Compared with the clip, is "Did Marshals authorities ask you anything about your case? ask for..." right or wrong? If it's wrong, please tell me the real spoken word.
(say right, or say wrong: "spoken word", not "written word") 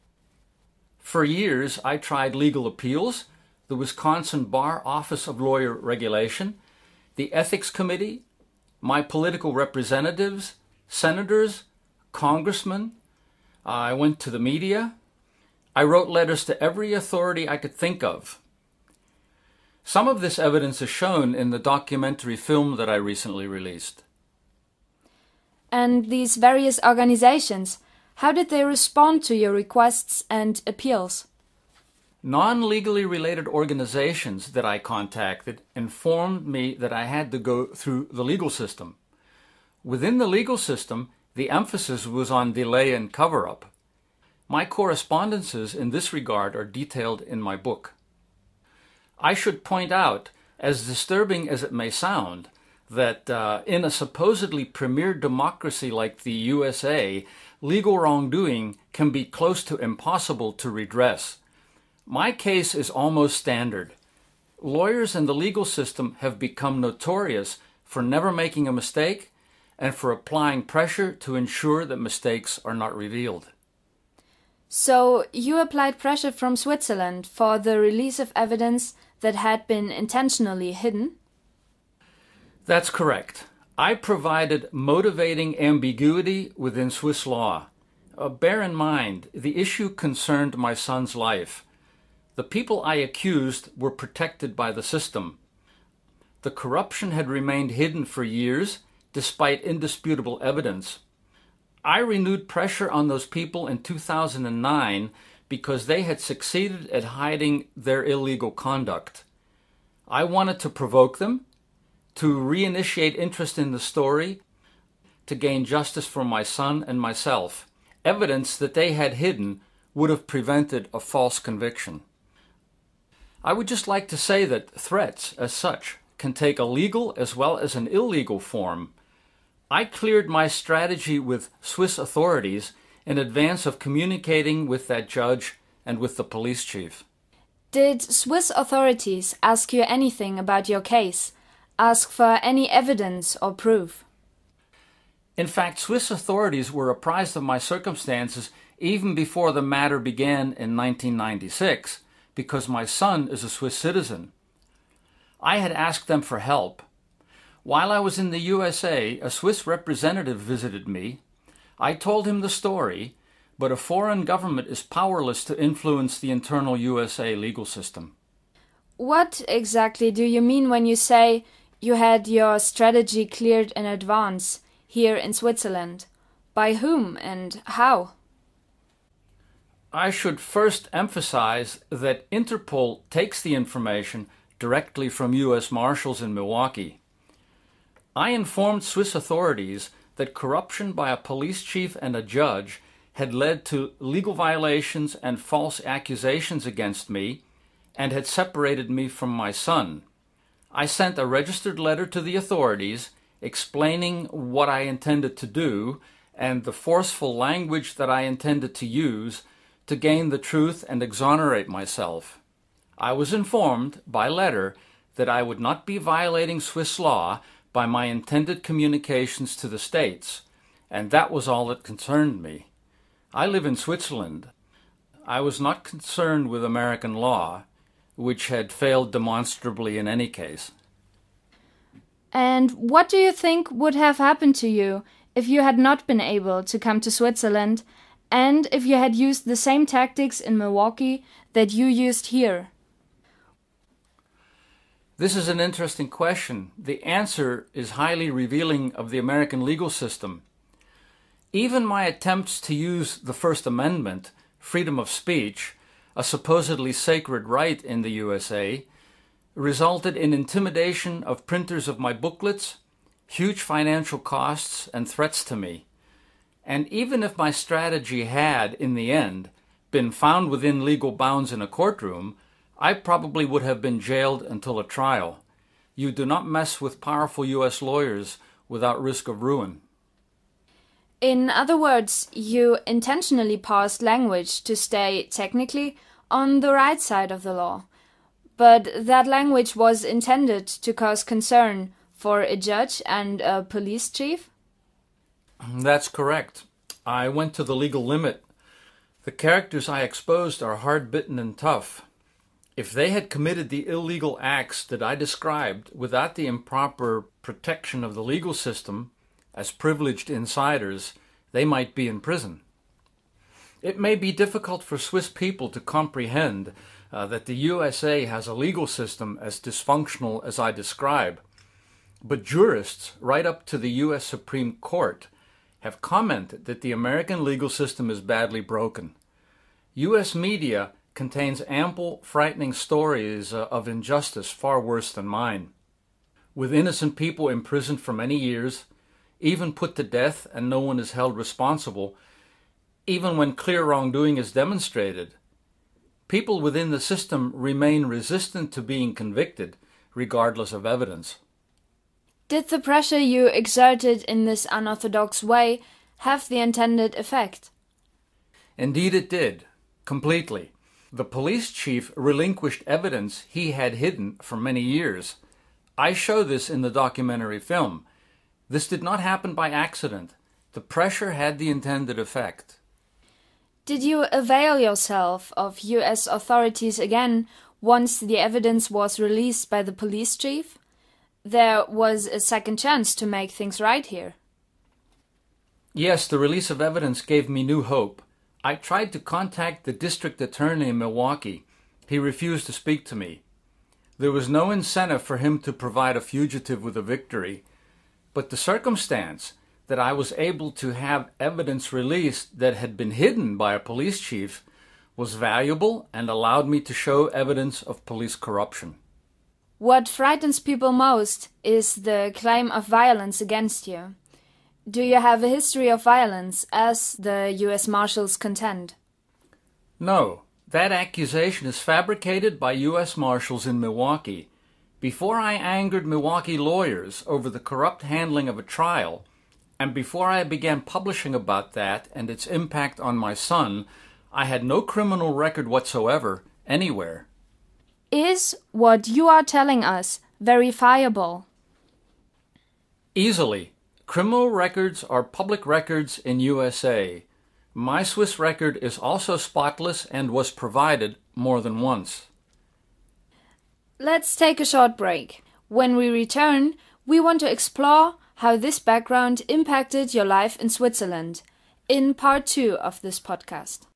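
wrong: "Swiss", not "Marshals".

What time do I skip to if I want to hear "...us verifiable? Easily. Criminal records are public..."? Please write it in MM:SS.
07:19.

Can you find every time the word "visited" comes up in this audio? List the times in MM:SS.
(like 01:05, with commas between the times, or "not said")
02:40.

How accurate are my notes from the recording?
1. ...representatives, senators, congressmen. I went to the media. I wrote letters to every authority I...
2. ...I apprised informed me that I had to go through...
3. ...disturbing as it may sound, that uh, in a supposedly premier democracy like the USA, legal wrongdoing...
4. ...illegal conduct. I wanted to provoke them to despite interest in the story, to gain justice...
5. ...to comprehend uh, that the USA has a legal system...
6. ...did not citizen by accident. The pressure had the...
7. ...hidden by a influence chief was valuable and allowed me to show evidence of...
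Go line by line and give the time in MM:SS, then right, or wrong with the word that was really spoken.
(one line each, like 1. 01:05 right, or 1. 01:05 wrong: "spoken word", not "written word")
1. 00:09 right
2. 00:34 wrong: "contacted", not "apprised"
3. 00:50 right
4. 01:48 wrong: "reinitiate", not "despite"
5. 05:15 right
6. 06:08 wrong: "happen", not "citizen"
7. 06:43 wrong: "police", not "influence".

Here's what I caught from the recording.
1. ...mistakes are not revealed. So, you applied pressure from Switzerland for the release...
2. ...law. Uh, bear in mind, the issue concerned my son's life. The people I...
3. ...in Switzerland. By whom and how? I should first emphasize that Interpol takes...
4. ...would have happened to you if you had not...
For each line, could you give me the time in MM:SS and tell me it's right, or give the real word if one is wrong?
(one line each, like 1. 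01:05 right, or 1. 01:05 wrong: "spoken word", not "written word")
1. 01:11 right
2. 01:27 right
3. 02:55 right
4. 03:53 right.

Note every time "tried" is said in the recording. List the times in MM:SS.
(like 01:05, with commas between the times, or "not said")
00:01, 06:28.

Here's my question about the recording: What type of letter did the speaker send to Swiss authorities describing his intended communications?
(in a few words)
Registered letter.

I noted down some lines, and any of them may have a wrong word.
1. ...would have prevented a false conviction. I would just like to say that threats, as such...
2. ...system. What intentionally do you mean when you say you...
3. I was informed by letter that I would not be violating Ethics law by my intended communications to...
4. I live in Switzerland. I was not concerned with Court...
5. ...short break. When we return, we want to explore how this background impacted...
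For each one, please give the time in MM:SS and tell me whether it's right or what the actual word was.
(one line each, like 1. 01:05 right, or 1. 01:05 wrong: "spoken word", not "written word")
1. 01:59 right
2. 02:47 wrong: "exactly", not "intentionally"
3. 03:32 wrong: "Swiss", not "Ethics"
4. 03:43 wrong: "American", not "Court"
5. 07:34 right.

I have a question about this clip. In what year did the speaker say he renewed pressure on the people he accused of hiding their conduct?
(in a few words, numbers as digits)
2009.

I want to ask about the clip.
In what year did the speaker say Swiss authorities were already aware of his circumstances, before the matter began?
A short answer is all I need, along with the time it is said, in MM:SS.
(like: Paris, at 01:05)
1996, at 02:30.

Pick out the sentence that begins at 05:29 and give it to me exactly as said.
US media contains ample, frightening stories uh, of injustice far worse than mine.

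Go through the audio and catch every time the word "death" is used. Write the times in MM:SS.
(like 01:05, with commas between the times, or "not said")
05:40.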